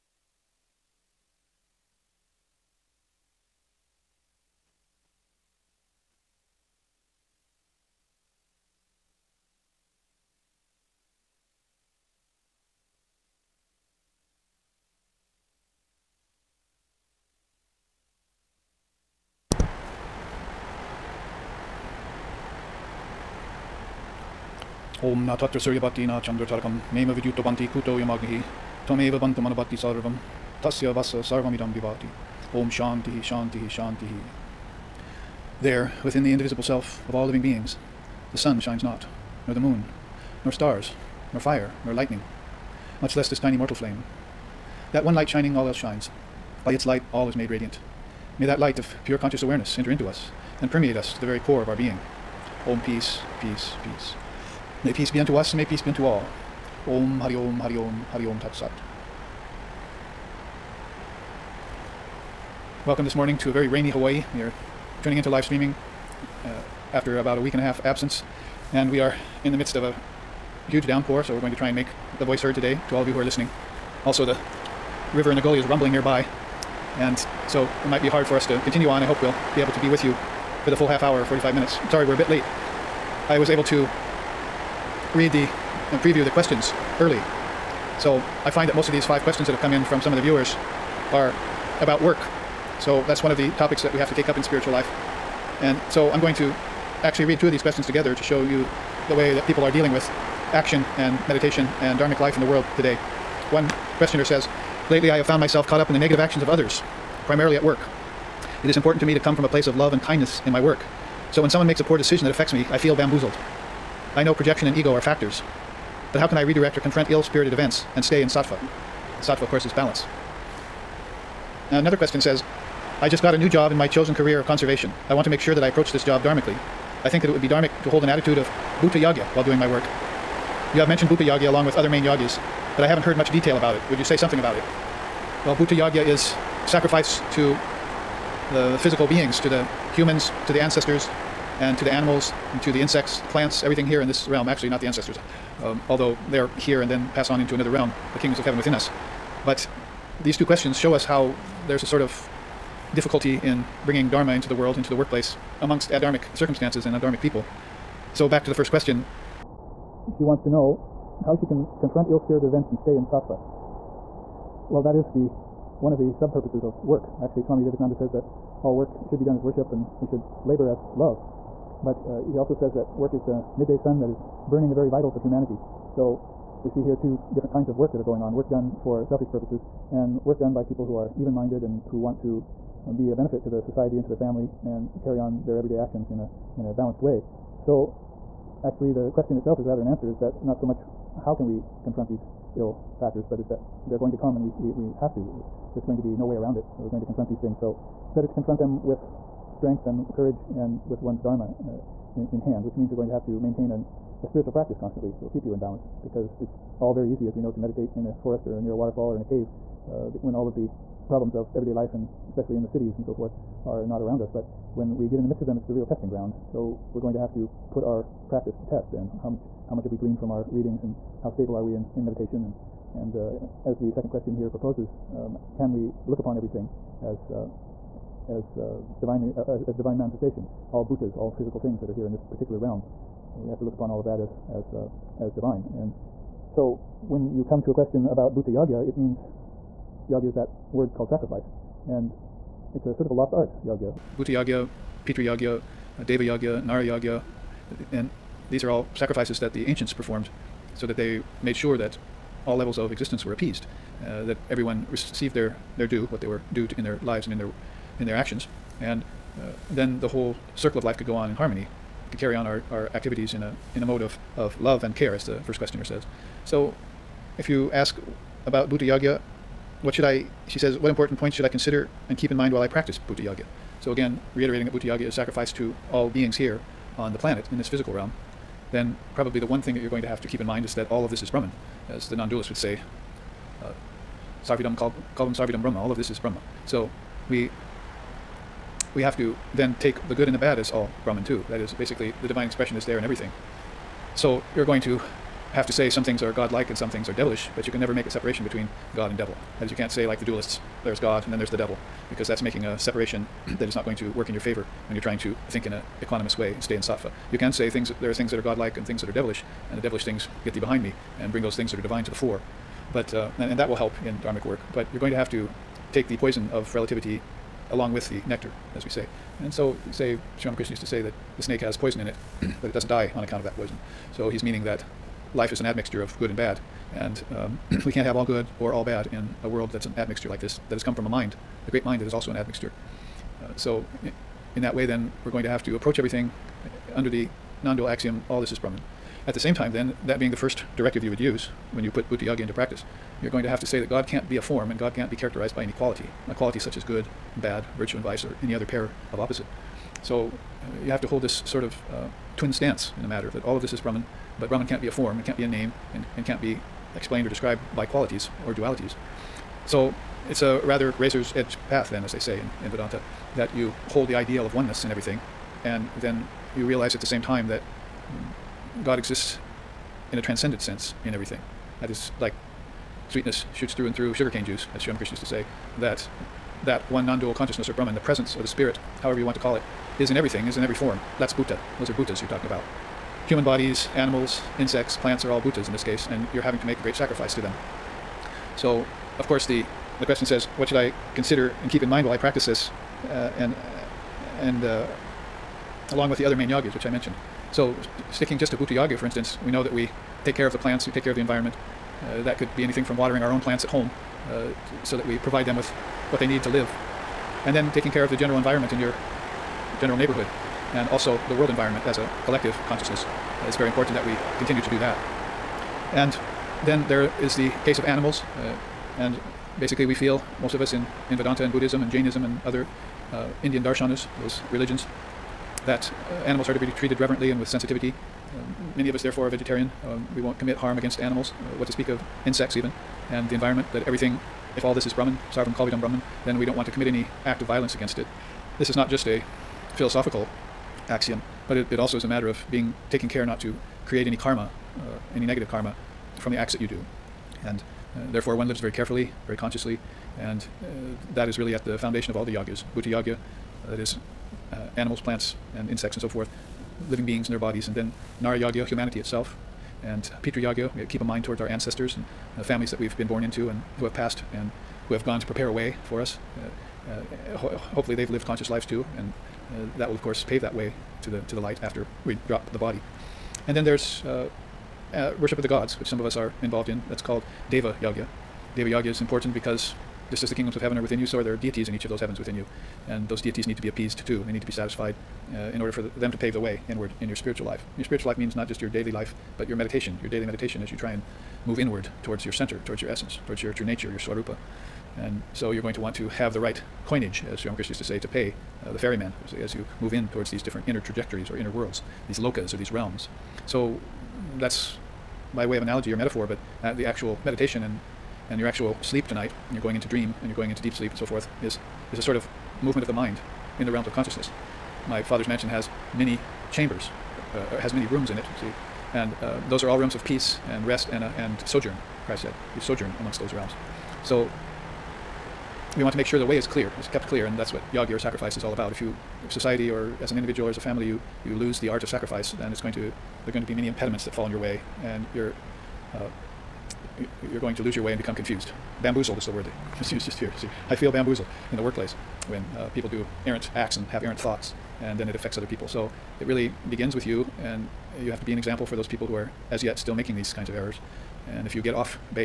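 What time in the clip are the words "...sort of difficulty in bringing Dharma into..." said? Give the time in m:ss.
2:31.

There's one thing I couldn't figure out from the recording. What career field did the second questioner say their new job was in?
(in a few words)
conservation.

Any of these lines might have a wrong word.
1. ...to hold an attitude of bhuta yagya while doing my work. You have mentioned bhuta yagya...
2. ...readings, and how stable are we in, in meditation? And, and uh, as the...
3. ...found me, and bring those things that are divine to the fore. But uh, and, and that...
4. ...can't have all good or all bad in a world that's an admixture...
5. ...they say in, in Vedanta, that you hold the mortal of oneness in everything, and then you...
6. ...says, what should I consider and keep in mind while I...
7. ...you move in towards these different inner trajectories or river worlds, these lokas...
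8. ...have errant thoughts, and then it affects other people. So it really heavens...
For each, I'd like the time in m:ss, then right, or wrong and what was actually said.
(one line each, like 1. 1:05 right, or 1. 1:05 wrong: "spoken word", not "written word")
1. 2:07 right
2. 3:40 right
3. 5:10 wrong: "behind", not "found"
4. 5:27 right
5. 6:02 wrong: "ideal", not "mortal"
6. 6:30 right
7. 8:19 wrong: "inner", not "river"
8. 9:03 wrong: "begins", not "heavens".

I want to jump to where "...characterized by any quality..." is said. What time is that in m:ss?
5:45.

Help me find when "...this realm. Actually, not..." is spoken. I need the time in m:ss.
2:24.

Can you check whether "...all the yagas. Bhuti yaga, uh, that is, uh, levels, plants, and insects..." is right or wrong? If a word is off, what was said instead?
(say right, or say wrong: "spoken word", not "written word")
wrong: "animals", not "levels".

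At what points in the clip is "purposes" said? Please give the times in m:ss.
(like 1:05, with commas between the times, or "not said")
2:46, 2:59.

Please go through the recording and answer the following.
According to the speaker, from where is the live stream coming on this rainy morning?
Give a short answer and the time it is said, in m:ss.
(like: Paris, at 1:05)
Hawaii, at 1:03.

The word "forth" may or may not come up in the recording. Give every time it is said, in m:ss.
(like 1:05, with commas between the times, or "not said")
3:33, 7:36, 8:31.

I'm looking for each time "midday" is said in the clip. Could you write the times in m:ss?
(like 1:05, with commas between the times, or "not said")
2:53.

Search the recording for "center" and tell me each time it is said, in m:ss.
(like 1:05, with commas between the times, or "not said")
8:12.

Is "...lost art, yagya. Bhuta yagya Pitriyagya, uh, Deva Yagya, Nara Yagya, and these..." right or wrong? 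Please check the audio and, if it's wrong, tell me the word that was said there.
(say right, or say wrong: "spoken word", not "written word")
right.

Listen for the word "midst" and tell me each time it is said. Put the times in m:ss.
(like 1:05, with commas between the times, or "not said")
1:09, 3:35.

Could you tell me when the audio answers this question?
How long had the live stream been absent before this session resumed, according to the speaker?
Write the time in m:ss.
1:07.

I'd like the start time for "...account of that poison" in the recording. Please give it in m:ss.
5:23.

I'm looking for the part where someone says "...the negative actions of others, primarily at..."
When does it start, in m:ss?
1:45.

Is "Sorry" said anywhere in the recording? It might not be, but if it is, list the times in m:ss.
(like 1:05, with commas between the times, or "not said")
1:21.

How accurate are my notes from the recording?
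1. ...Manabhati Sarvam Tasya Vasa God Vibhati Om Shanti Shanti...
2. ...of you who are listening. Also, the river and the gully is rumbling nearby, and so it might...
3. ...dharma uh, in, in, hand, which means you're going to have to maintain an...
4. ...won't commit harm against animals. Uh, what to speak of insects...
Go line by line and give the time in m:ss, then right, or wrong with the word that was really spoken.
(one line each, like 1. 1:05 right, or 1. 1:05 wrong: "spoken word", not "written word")
1. 0:29 wrong: "Sarvamidam", not "God"
2. 1:13 right
3. 3:21 right
4. 7:10 right.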